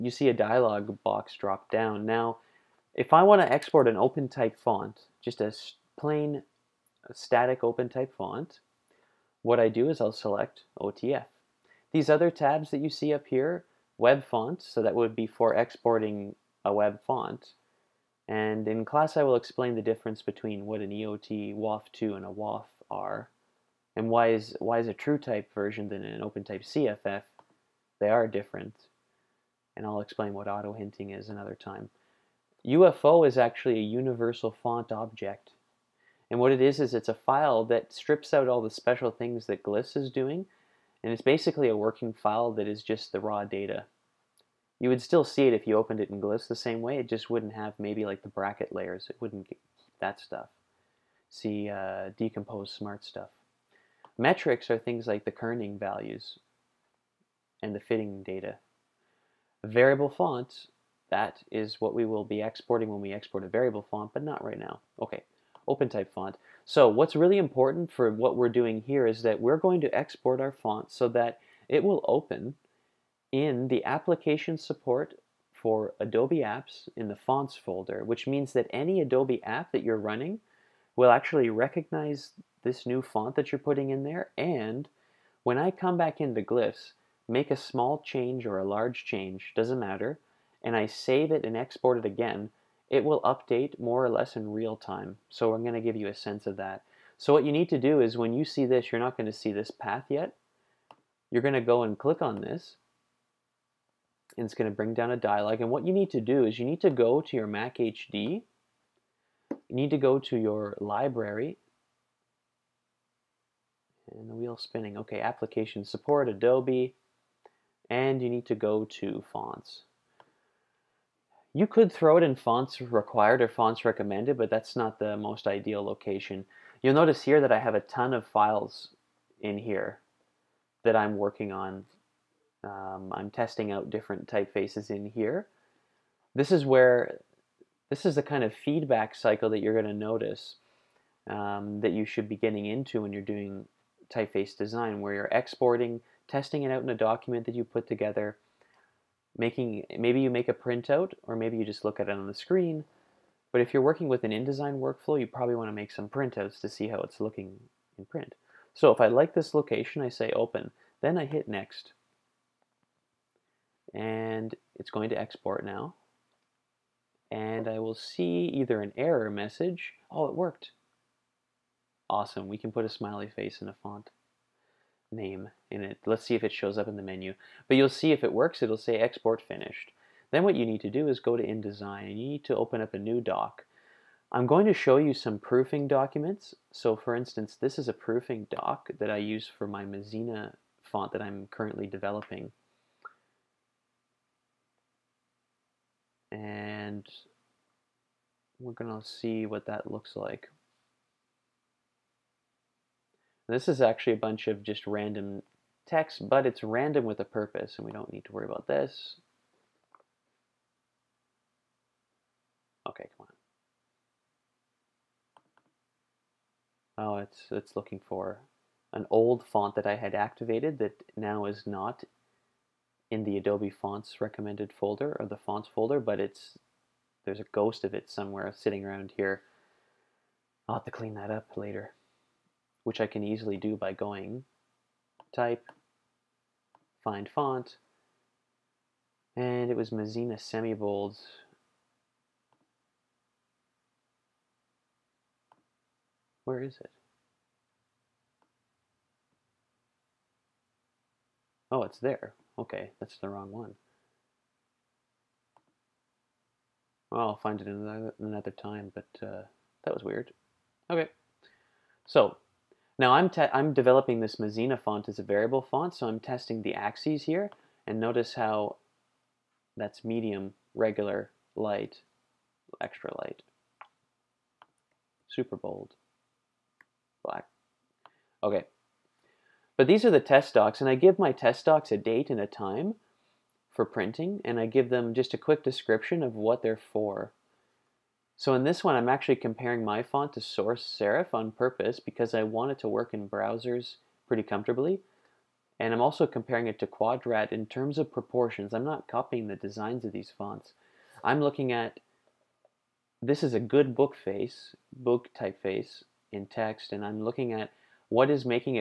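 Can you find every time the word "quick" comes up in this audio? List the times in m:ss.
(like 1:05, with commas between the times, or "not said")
4:45.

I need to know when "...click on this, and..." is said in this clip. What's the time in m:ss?
1:41.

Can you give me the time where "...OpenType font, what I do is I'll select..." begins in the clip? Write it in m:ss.
0:07.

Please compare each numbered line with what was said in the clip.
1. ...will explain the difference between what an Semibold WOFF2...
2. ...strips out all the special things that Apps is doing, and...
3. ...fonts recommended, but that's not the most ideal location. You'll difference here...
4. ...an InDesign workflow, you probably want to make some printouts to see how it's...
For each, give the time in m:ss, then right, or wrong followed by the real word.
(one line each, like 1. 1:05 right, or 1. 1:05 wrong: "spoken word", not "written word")
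1. 0:19 wrong: "EOT", not "Semibold"
2. 0:37 wrong: "Glyphs", not "Apps"
3. 2:03 wrong: "notice", not "difference"
4. 2:34 right.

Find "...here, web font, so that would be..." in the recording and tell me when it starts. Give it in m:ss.
0:13.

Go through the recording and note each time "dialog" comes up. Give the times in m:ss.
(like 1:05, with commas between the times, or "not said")
0:00, 1:45.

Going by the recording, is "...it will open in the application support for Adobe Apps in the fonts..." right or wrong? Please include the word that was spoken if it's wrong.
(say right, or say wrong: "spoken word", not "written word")
right.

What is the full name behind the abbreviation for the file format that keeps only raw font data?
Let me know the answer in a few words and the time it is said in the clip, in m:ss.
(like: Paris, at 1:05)
Universal font object, at 0:33.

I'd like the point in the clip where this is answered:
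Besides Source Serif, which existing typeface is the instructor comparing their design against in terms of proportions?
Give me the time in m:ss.
4:56.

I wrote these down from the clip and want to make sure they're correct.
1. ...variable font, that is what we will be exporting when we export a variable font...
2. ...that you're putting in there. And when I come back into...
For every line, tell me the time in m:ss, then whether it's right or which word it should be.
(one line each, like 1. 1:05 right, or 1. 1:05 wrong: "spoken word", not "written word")
1. 0:59 right
2. 1:23 right.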